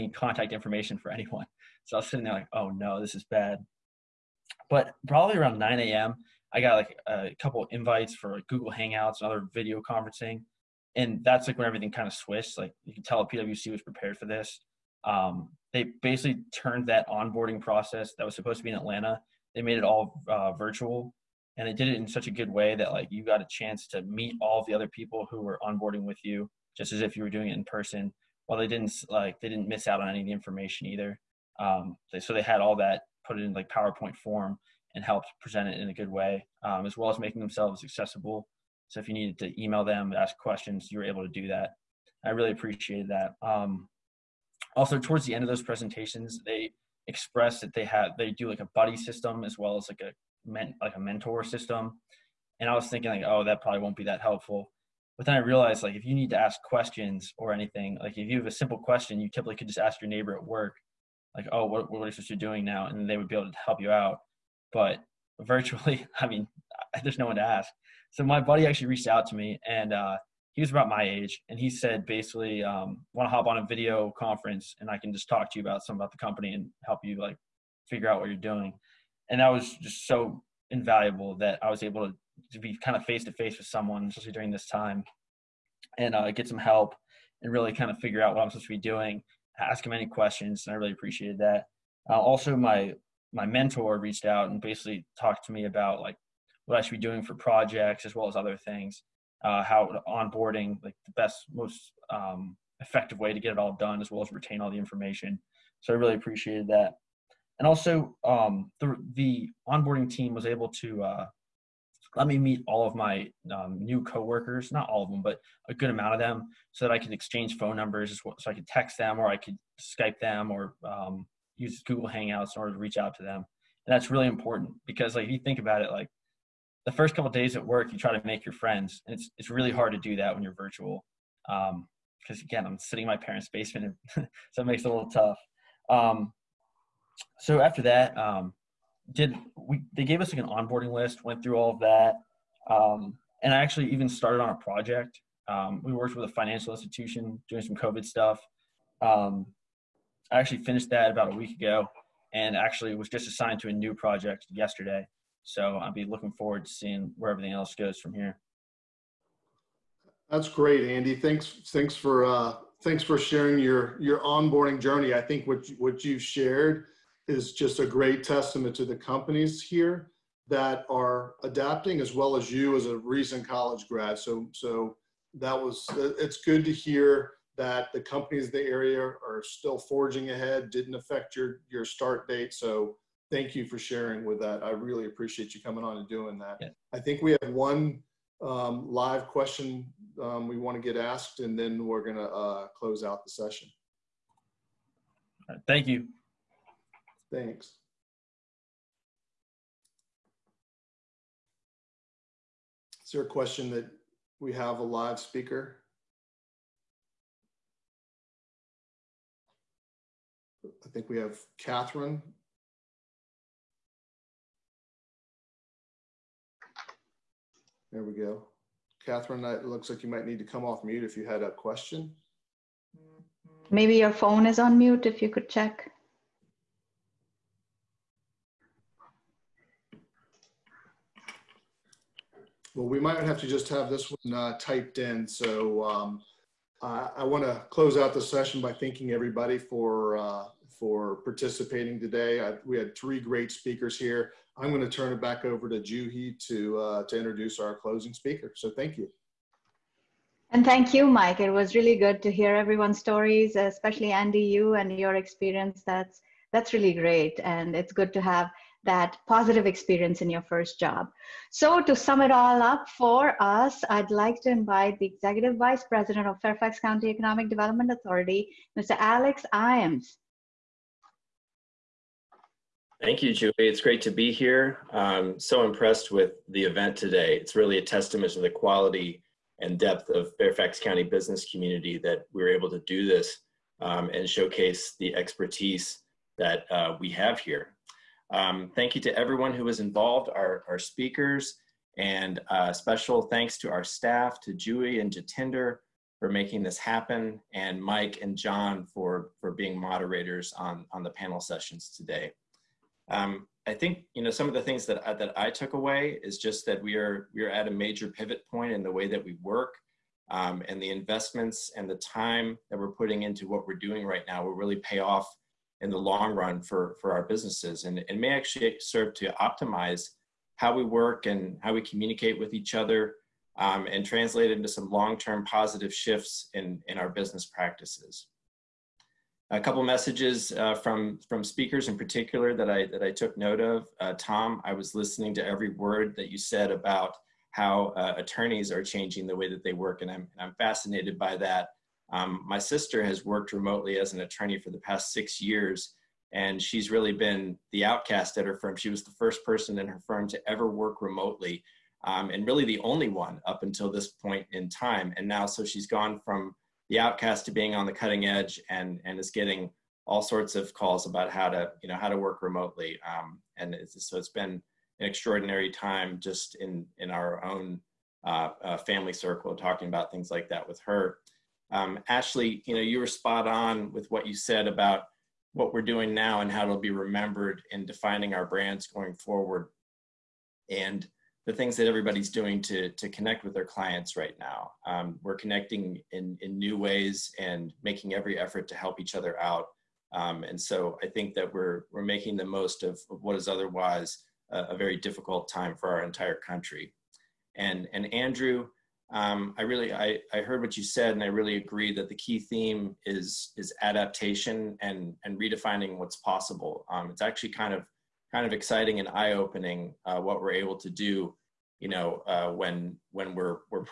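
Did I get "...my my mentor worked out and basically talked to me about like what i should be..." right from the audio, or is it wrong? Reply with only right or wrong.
wrong.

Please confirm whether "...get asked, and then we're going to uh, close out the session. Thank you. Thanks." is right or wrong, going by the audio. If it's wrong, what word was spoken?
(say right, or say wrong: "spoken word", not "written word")
right.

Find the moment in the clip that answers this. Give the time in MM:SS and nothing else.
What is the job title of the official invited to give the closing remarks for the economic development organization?
04:25.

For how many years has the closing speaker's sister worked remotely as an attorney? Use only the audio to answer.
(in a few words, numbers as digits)
6.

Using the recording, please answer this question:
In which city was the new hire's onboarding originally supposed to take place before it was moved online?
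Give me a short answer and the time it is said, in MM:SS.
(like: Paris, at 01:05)
Atlanta, at 00:18.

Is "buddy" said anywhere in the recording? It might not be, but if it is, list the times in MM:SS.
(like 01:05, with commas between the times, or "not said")
00:48, 01:08.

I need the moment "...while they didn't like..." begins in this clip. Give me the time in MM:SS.
00:28.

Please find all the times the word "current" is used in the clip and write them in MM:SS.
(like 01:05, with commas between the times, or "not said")
not said.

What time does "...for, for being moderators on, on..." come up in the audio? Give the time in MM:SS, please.
04:58.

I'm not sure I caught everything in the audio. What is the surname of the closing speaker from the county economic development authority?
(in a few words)
Iams.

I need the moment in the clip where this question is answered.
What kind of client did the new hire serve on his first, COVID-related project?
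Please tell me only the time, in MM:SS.
02:26.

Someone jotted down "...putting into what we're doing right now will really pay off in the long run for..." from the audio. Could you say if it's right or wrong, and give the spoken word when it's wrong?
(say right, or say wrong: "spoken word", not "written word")
right.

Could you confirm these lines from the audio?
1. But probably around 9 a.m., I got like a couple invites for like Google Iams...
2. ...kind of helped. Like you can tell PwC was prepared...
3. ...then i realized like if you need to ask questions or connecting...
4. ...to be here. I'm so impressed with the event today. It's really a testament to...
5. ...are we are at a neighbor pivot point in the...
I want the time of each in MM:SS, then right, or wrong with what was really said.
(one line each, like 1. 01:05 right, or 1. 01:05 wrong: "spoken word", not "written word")
1. 00:04 wrong: "Hangouts", not "Iams"
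2. 00:11 wrong: "switched", not "helped"
3. 00:55 wrong: "anything", not "connecting"
4. 04:34 right
5. 05:06 wrong: "major", not "neighbor".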